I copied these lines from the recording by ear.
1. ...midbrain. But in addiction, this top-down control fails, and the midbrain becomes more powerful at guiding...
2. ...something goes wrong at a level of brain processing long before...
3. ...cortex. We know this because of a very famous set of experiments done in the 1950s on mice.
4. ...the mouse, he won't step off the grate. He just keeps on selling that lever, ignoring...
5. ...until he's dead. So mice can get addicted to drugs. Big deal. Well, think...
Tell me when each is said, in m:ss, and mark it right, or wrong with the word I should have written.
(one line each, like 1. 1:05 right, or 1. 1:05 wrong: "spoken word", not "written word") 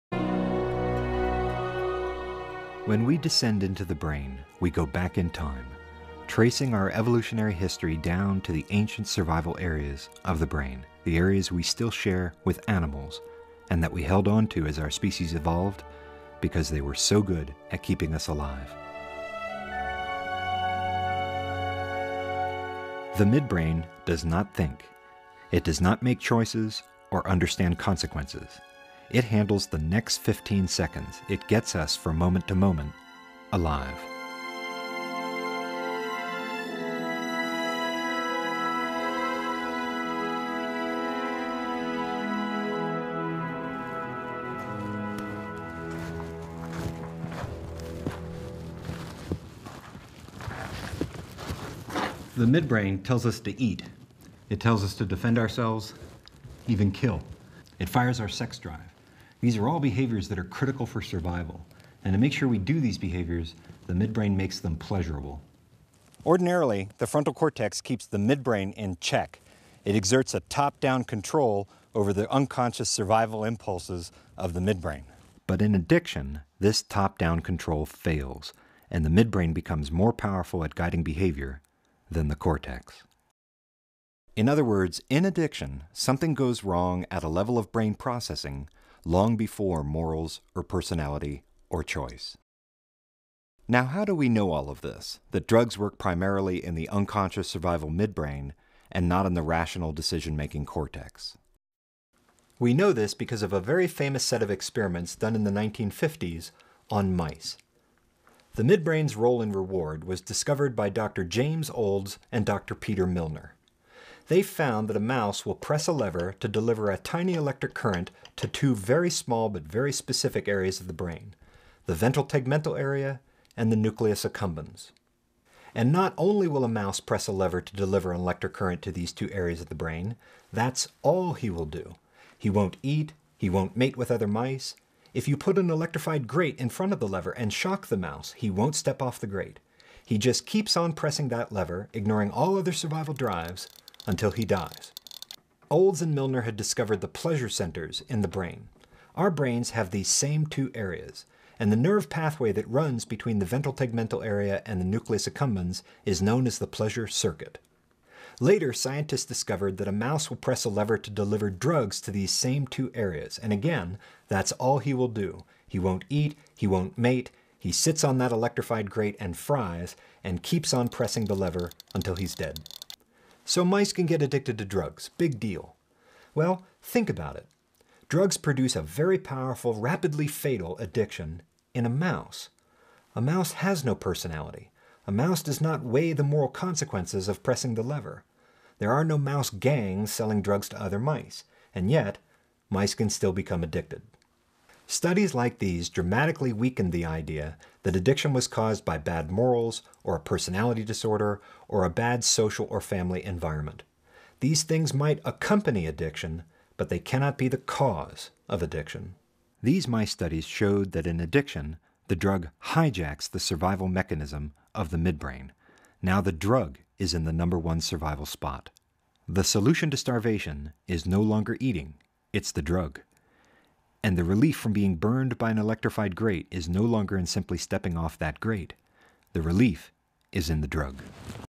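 1. 1:14 right
2. 1:25 right
3. 1:40 right
4. 2:17 wrong: "pressing", not "selling"
5. 2:51 right.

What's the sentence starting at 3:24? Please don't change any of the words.
These things might accompany addiction, but they cannot be the cause of addiction.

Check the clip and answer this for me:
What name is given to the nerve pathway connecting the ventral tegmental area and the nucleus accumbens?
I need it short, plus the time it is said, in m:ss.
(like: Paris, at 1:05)
the pleasure circuit, at 2:36.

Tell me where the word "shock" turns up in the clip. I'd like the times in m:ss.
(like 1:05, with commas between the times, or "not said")
2:17.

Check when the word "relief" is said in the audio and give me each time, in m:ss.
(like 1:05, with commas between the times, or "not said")
3:44, 3:49.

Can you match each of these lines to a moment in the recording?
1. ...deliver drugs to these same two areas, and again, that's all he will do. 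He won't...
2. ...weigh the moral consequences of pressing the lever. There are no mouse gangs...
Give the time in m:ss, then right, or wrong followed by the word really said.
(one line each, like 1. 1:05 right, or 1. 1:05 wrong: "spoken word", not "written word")
1. 2:41 right
2. 3:05 right.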